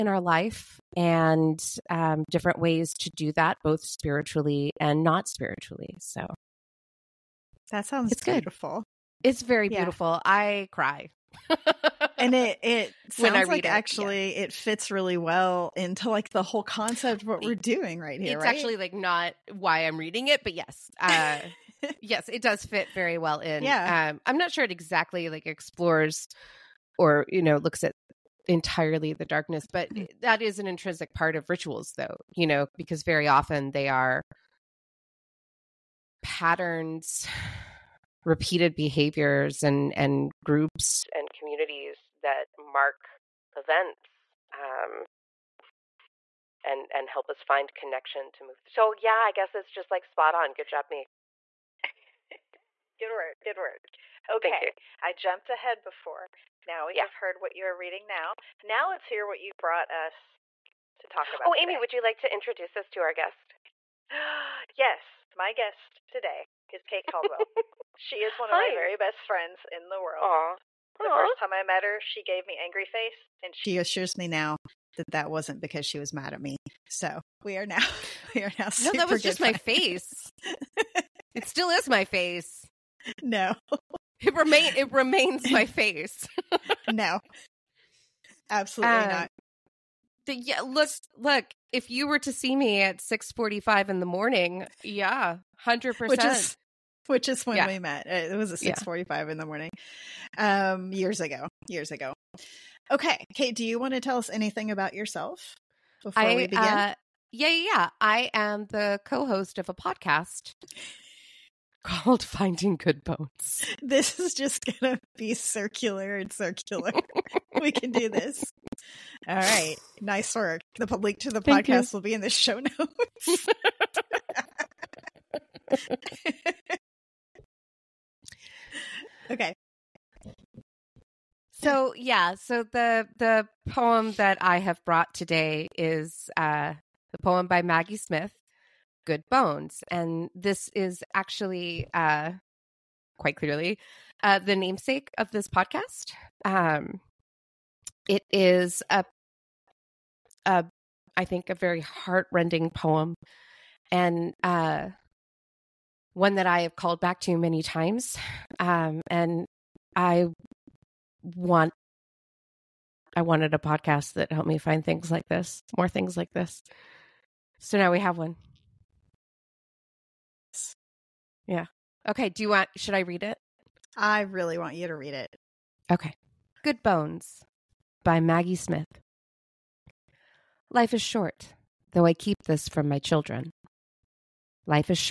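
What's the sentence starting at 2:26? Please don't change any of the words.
Um, it is a, a, I think, a very heartrending poem, and uh, one that I have called back to many times.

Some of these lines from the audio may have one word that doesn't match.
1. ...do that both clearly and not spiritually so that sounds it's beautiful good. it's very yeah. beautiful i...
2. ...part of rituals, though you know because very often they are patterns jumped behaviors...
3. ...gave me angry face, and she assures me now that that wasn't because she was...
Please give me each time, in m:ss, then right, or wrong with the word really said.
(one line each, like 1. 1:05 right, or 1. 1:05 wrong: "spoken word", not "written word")
1. 0:03 wrong: "spiritually", not "clearly"
2. 0:31 wrong: "repeated", not "jumped"
3. 1:12 right.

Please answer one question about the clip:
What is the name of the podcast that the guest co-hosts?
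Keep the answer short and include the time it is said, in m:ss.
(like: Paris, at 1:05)
Finding Good Bones, at 1:52.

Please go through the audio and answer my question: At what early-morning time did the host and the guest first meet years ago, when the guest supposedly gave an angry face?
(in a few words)
6:45.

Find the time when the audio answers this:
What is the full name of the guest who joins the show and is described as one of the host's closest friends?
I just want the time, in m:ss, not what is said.
1:06.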